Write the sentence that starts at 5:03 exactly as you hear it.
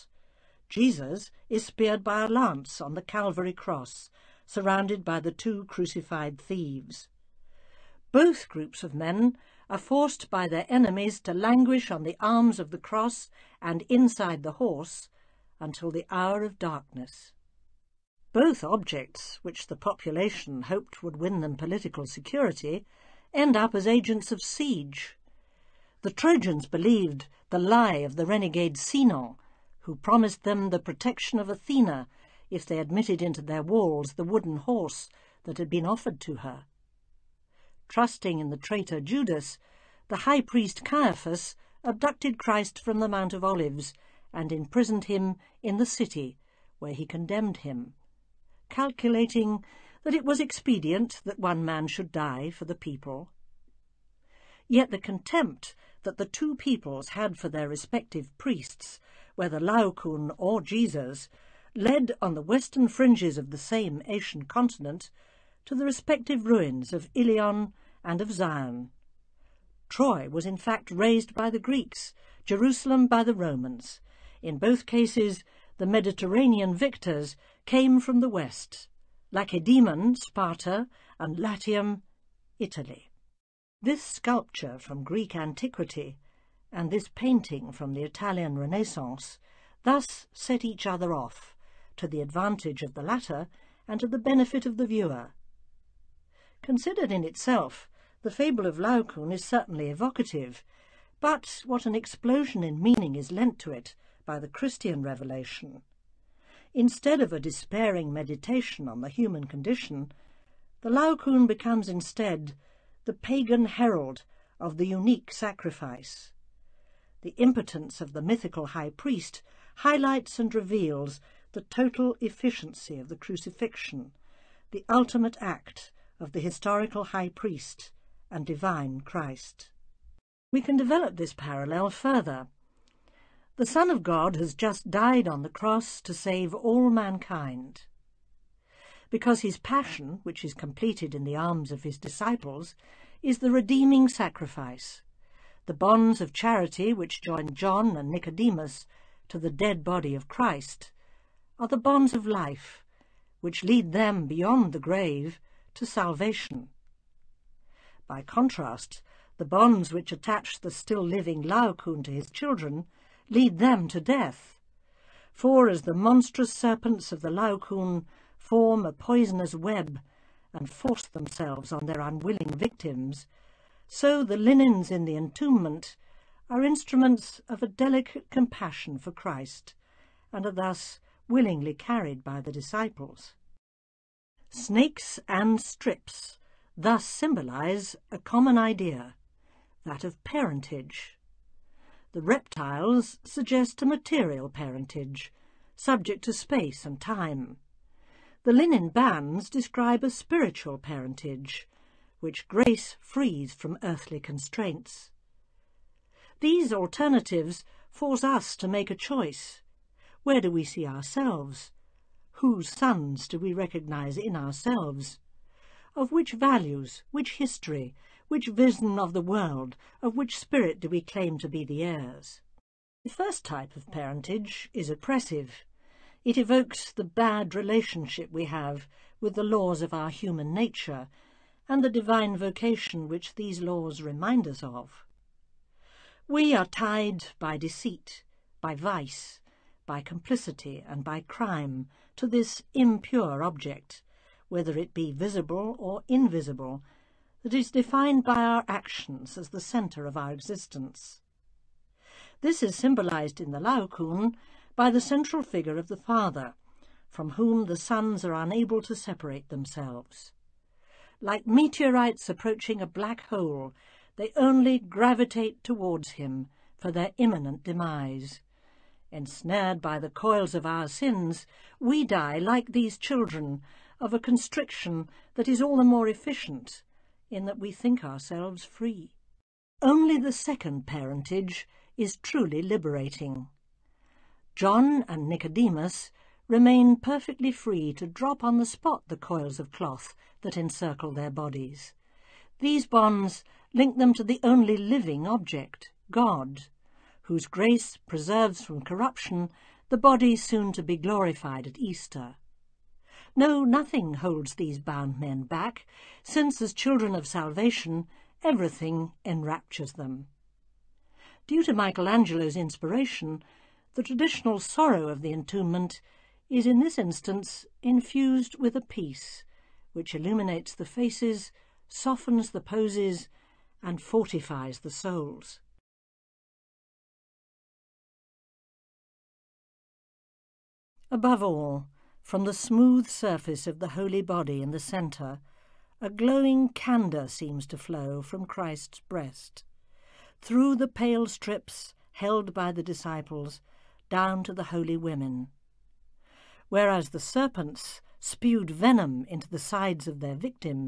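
No, nothing holds these bound men back, since as children of salvation, everything enraptures them.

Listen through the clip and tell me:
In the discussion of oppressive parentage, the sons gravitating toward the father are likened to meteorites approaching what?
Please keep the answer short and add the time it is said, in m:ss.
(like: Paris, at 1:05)
a black hole, at 4:22.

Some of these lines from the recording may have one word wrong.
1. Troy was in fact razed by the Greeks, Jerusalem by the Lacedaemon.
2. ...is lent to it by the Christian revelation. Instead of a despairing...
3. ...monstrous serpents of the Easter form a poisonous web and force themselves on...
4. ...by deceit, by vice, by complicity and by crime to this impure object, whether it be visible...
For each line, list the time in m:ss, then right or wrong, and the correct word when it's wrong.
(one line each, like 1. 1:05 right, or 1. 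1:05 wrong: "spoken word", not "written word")
1. 1:09 wrong: "Romans", not "Lacedaemon"
2. 1:43 right
3. 2:45 wrong: "Laocoon", not "Easter"
4. 3:57 right.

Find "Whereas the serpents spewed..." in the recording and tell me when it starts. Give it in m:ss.
5:46.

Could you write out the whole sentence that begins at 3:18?
The linen bands describe a spiritual parentage, which grace frees from earthly constraints.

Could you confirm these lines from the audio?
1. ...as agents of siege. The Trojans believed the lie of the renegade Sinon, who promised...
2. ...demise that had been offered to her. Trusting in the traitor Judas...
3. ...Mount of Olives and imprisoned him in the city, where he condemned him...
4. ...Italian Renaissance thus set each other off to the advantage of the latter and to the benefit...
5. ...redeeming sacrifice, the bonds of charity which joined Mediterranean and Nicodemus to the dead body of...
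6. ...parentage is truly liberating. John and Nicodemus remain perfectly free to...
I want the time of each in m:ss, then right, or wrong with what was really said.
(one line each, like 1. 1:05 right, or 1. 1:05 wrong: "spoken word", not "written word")
1. 0:23 right
2. 0:34 wrong: "horse", not "demise"
3. 0:43 right
4. 1:28 right
5. 2:23 wrong: "John", not "Mediterranean"
6. 4:40 right.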